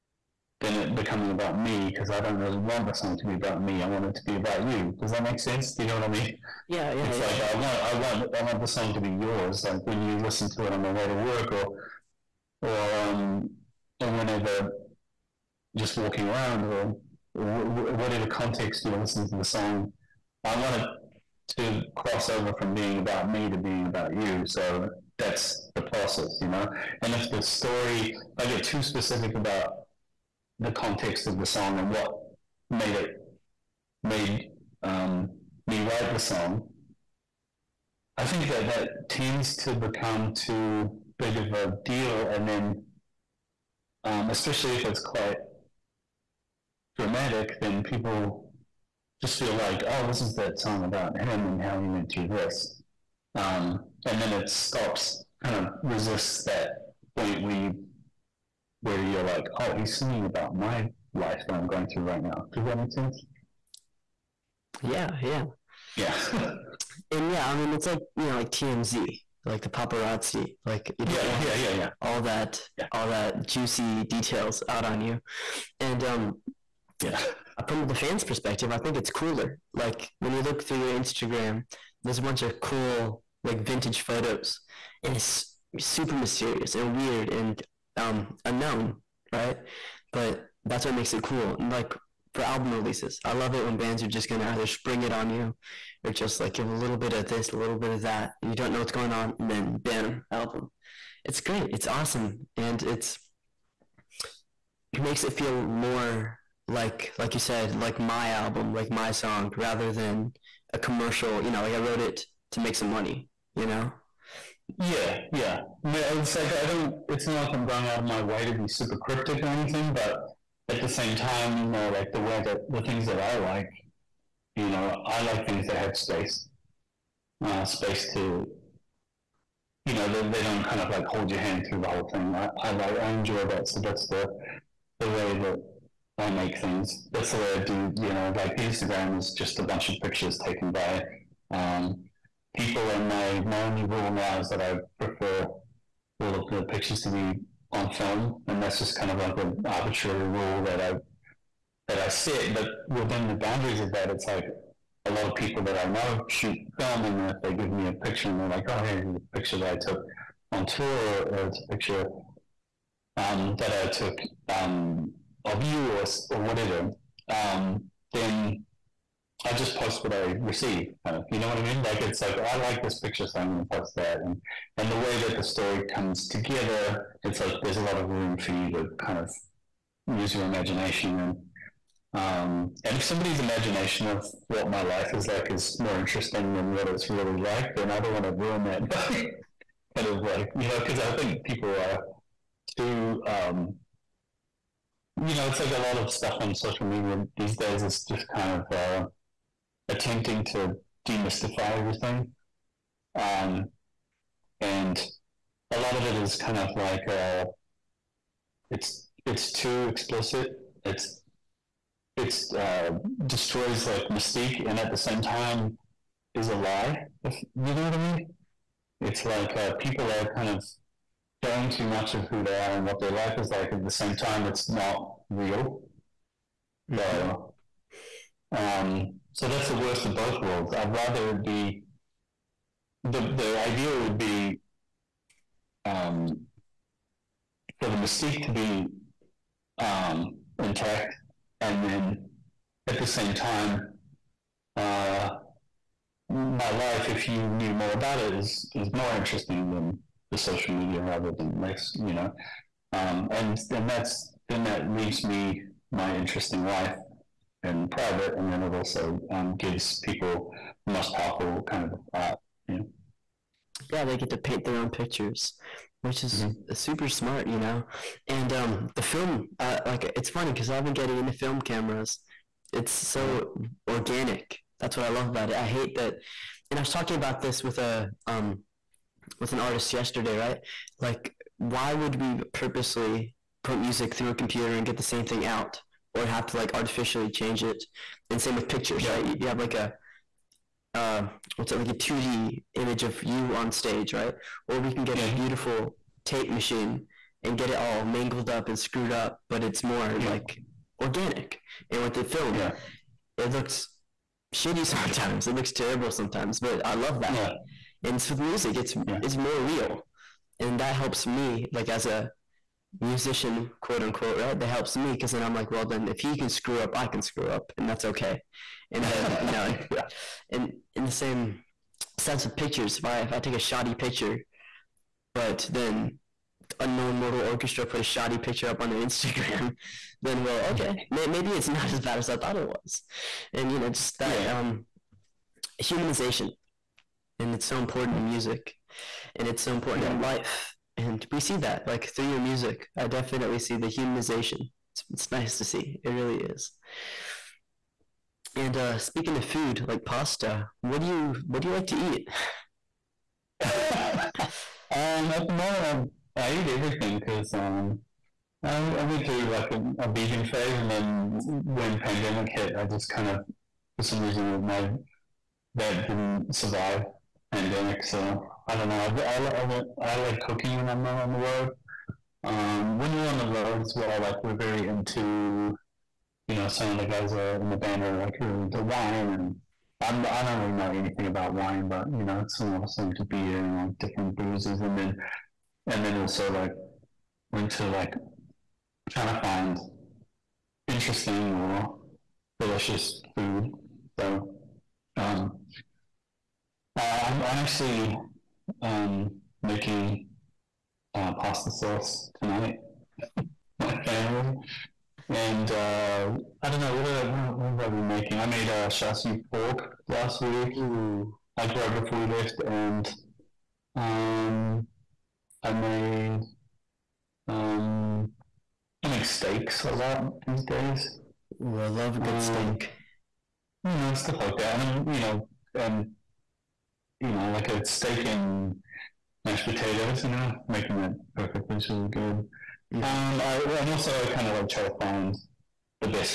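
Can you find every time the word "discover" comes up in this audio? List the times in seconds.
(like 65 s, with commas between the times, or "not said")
not said.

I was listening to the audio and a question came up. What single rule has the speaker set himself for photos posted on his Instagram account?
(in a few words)
On film.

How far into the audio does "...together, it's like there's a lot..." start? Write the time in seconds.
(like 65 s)
176 s.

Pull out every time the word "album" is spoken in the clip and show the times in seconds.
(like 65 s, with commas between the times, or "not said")
92 s, 100 s, 108 s.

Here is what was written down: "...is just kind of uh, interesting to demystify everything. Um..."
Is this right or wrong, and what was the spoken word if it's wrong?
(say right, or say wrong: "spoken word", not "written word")
wrong: "attempting", not "interesting".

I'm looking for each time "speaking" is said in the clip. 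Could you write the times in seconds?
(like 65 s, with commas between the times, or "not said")
348 s.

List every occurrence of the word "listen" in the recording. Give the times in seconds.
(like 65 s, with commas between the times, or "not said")
10 s, 18 s.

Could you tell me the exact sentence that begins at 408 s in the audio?
I made a uh, chassis pork last week, Ooh.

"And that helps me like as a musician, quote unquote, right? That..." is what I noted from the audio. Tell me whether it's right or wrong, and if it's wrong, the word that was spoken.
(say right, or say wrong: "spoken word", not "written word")
right.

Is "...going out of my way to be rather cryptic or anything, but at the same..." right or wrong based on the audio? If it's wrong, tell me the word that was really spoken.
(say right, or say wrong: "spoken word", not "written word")
wrong: "super", not "rather".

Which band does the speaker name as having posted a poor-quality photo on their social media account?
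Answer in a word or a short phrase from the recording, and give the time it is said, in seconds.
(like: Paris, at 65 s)
Unknown Mortal Orchestra, at 326 s.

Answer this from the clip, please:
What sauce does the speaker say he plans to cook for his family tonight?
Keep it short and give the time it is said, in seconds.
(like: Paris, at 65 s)
Pasta sauce, at 401 s.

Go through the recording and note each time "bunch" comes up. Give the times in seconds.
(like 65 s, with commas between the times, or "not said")
82 s, 139 s.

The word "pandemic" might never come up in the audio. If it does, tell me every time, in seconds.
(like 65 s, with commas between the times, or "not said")
361 s, 367 s.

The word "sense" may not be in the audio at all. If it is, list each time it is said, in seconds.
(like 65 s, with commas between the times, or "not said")
5 s, 62 s, 322 s.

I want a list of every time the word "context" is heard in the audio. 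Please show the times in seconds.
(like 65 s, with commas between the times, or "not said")
18 s, 30 s.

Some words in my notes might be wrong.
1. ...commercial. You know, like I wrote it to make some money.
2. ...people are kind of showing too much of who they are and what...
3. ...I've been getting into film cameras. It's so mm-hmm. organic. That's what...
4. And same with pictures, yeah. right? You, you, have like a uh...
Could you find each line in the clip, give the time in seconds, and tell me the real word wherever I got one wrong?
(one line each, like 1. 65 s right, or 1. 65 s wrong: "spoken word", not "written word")
1. 110 s right
2. 219 s right
3. 270 s right
4. 288 s right.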